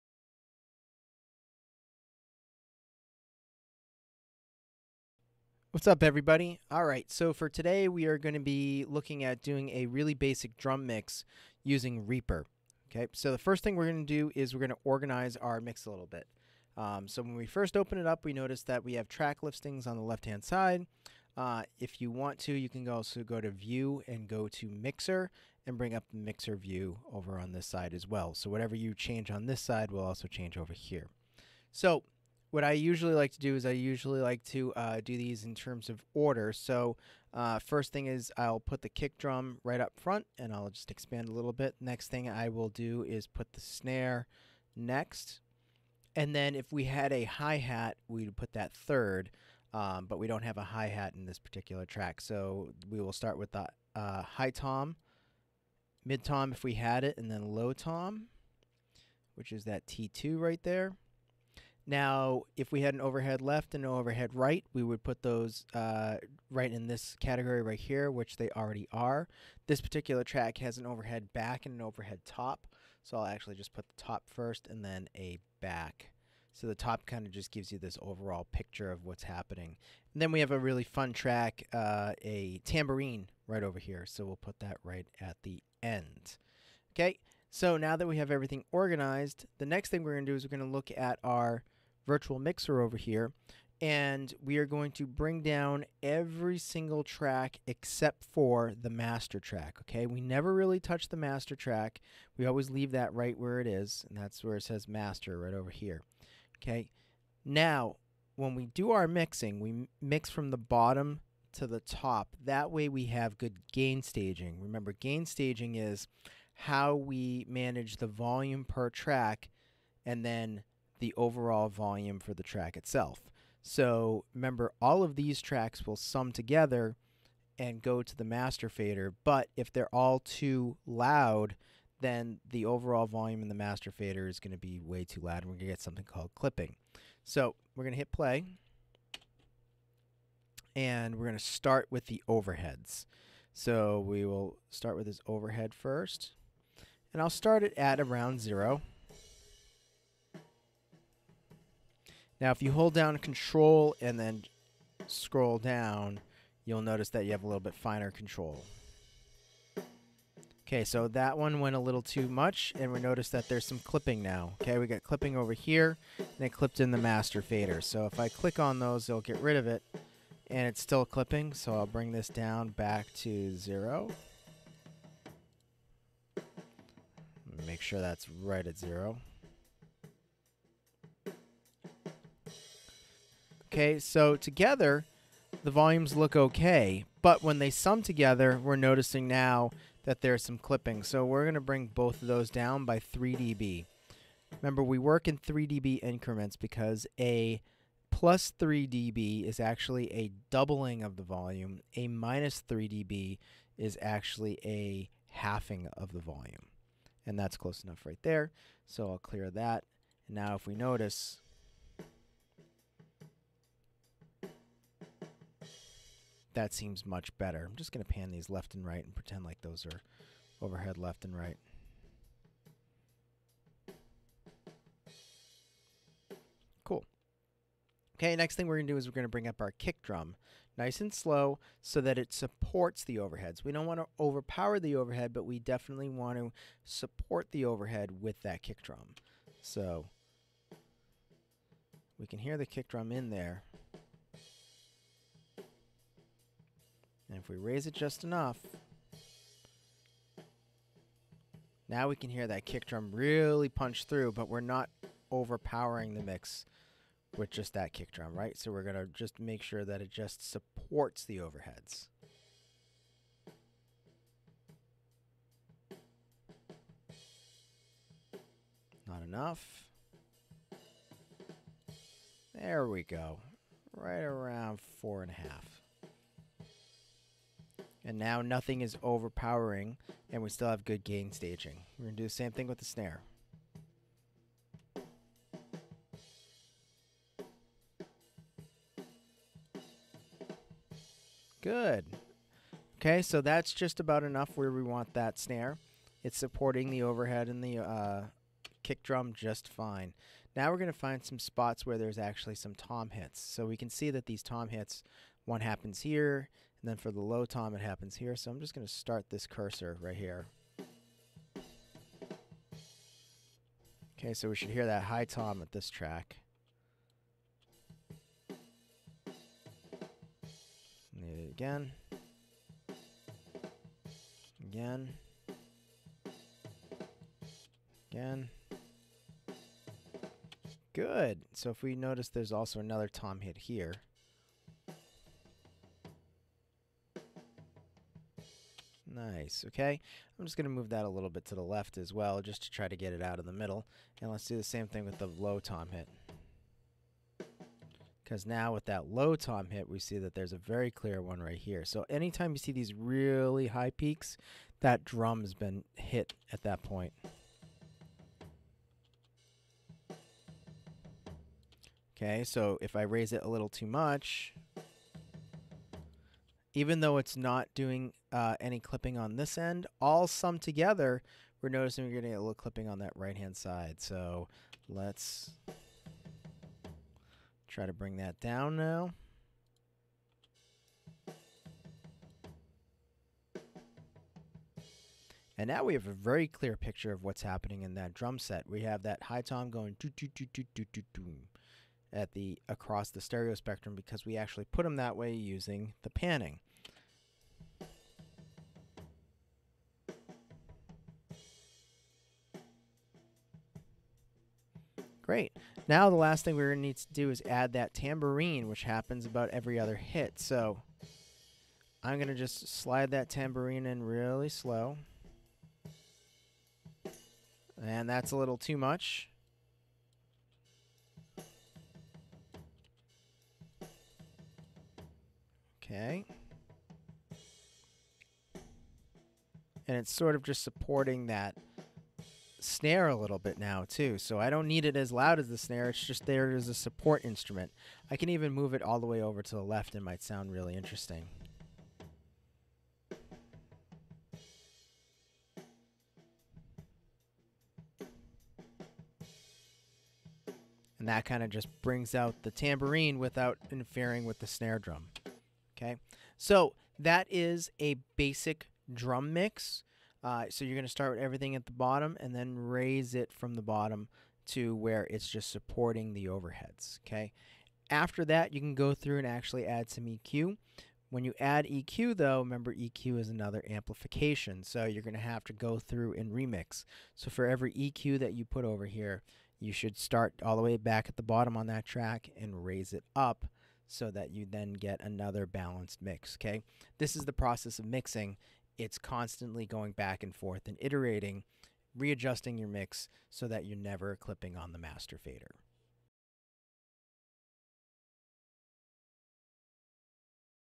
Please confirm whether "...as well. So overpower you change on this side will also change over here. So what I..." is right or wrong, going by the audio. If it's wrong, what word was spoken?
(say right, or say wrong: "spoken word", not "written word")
wrong: "whatever", not "overpower".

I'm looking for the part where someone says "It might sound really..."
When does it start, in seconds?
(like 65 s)
439 s.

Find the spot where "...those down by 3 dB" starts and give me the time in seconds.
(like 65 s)
192 s.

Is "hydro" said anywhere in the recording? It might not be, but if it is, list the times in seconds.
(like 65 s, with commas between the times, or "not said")
not said.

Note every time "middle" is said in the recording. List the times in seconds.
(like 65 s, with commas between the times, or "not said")
343 s.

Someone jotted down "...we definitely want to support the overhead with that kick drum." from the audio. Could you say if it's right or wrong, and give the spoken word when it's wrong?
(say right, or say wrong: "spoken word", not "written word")
right.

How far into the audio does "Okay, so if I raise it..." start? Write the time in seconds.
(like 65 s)
362 s.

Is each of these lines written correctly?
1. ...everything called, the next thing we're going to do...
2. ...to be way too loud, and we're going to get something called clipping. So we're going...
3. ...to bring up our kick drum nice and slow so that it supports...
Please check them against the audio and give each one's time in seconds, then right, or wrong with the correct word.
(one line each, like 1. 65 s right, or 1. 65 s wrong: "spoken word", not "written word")
1. 88 s wrong: "organized", not "called"
2. 134 s right
3. 229 s right.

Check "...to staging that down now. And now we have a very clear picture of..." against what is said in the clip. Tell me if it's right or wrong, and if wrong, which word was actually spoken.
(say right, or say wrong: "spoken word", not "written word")
wrong: "bring", not "staging".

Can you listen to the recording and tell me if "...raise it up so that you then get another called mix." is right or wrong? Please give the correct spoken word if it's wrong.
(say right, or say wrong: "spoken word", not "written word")
wrong: "balanced", not "called".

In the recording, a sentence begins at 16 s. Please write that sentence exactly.
Um, so when we first open it up, we notice that we have track listings on the left-hand side.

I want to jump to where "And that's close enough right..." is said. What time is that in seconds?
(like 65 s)
207 s.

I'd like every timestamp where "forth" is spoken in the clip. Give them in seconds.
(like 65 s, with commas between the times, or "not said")
490 s.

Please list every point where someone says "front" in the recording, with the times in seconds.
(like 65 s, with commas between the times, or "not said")
39 s.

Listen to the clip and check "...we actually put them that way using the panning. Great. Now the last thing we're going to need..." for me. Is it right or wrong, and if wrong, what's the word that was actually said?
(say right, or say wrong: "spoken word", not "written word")
right.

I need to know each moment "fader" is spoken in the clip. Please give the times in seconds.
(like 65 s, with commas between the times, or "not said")
128 s, 133 s, 167 s, 495 s.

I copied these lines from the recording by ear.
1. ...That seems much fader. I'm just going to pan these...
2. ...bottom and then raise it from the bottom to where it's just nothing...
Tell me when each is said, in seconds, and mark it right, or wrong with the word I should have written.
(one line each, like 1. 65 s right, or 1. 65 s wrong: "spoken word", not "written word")
1. 216 s wrong: "better", not "fader"
2. 461 s wrong: "supporting", not "nothing".